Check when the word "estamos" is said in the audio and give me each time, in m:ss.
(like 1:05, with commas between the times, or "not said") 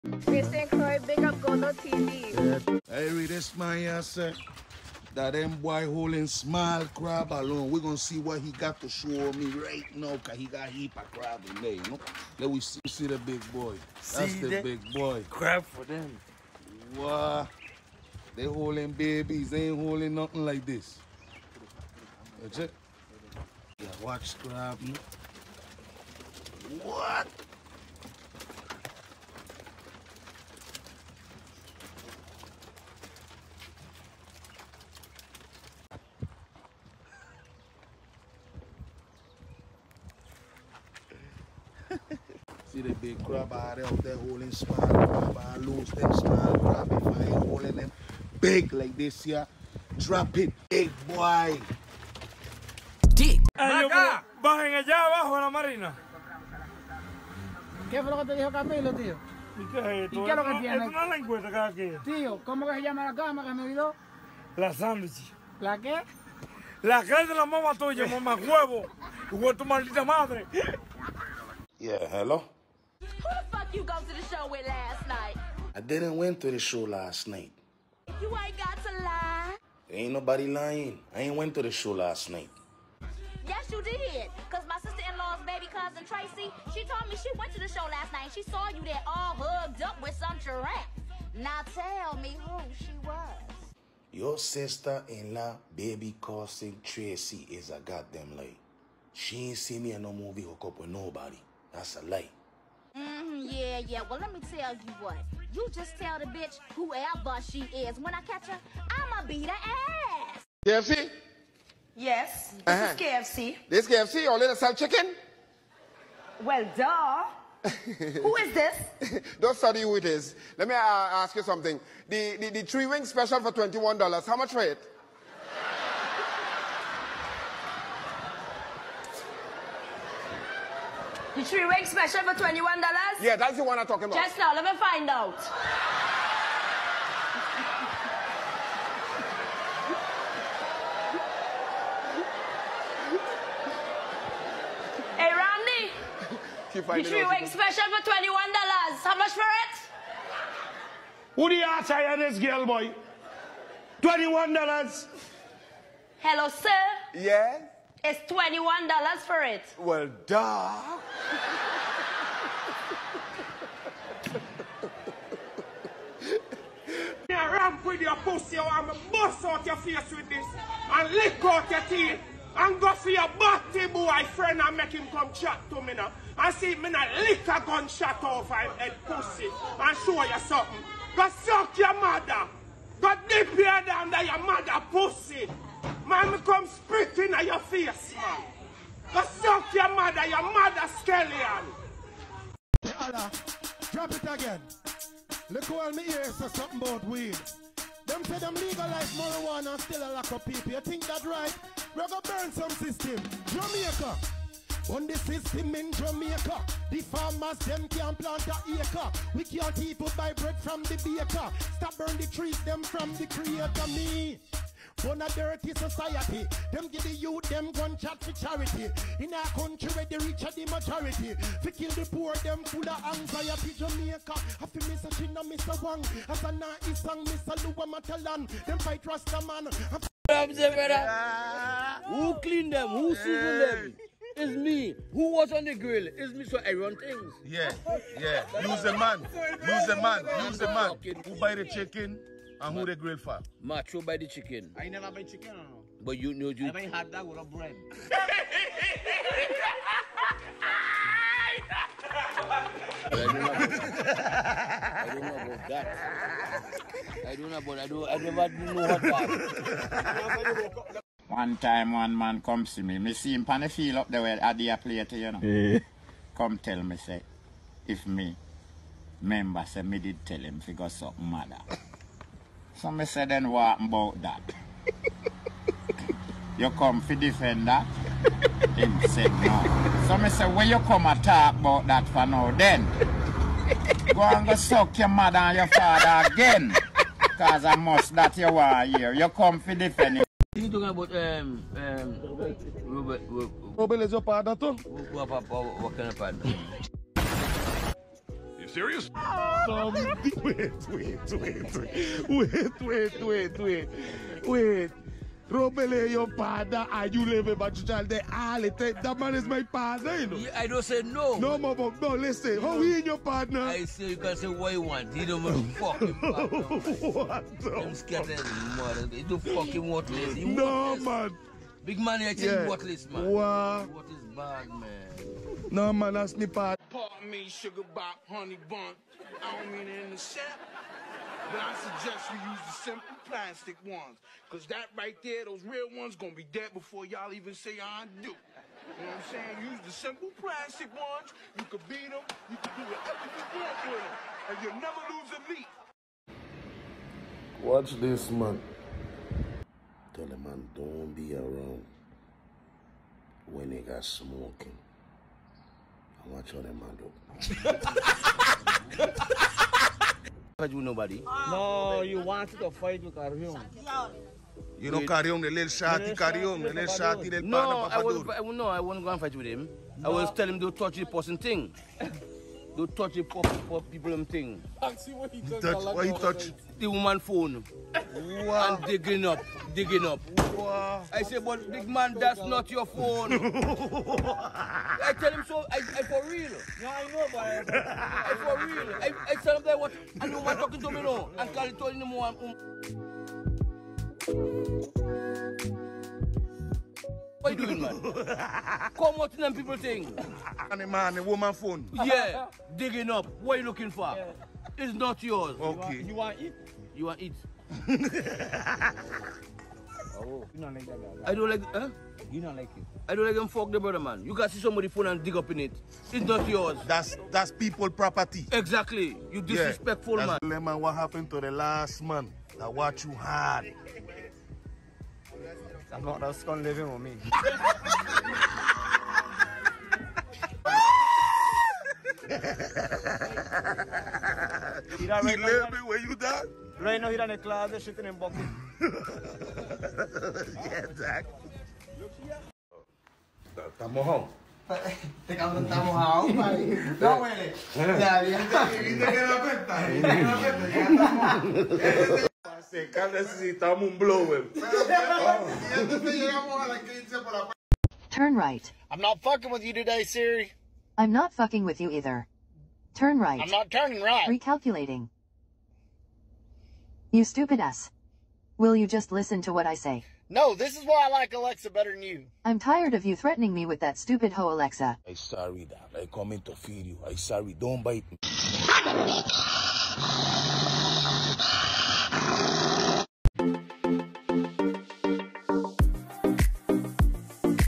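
7:23, 7:31.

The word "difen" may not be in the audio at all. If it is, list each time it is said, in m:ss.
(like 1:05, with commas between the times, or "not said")
4:37, 4:49.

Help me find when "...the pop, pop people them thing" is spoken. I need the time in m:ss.
6:13.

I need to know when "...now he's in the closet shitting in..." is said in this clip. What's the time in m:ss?
7:17.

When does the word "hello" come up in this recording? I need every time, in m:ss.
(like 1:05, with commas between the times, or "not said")
1:12, 2:36.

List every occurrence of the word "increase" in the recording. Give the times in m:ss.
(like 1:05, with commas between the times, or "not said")
not said.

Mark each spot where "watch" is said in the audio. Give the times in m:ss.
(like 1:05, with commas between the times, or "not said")
0:24, 5:47, 7:02.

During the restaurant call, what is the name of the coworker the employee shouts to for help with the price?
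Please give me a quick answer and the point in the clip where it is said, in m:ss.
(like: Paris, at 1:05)
Randy, at 2:25.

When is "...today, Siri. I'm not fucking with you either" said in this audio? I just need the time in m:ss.
7:39.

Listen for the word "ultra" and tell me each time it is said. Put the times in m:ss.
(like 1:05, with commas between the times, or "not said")
not said.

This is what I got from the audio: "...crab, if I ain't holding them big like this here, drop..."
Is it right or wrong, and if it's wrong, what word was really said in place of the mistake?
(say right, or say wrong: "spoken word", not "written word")
right.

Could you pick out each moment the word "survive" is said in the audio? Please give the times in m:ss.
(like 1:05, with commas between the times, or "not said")
not said.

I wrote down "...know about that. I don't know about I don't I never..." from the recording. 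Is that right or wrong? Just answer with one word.
right.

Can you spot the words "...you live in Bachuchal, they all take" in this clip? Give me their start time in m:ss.
5:07.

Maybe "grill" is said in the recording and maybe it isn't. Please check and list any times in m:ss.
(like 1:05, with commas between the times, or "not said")
3:55, 4:02.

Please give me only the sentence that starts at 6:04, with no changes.
You know Karyong, the little shati Karyong, the little shati, the No, I was, no, I won't go and fight with him.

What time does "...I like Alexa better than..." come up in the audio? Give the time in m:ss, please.
7:51.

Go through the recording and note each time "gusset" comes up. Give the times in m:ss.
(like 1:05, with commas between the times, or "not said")
not said.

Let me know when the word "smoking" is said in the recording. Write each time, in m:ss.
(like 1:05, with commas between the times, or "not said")
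5:54.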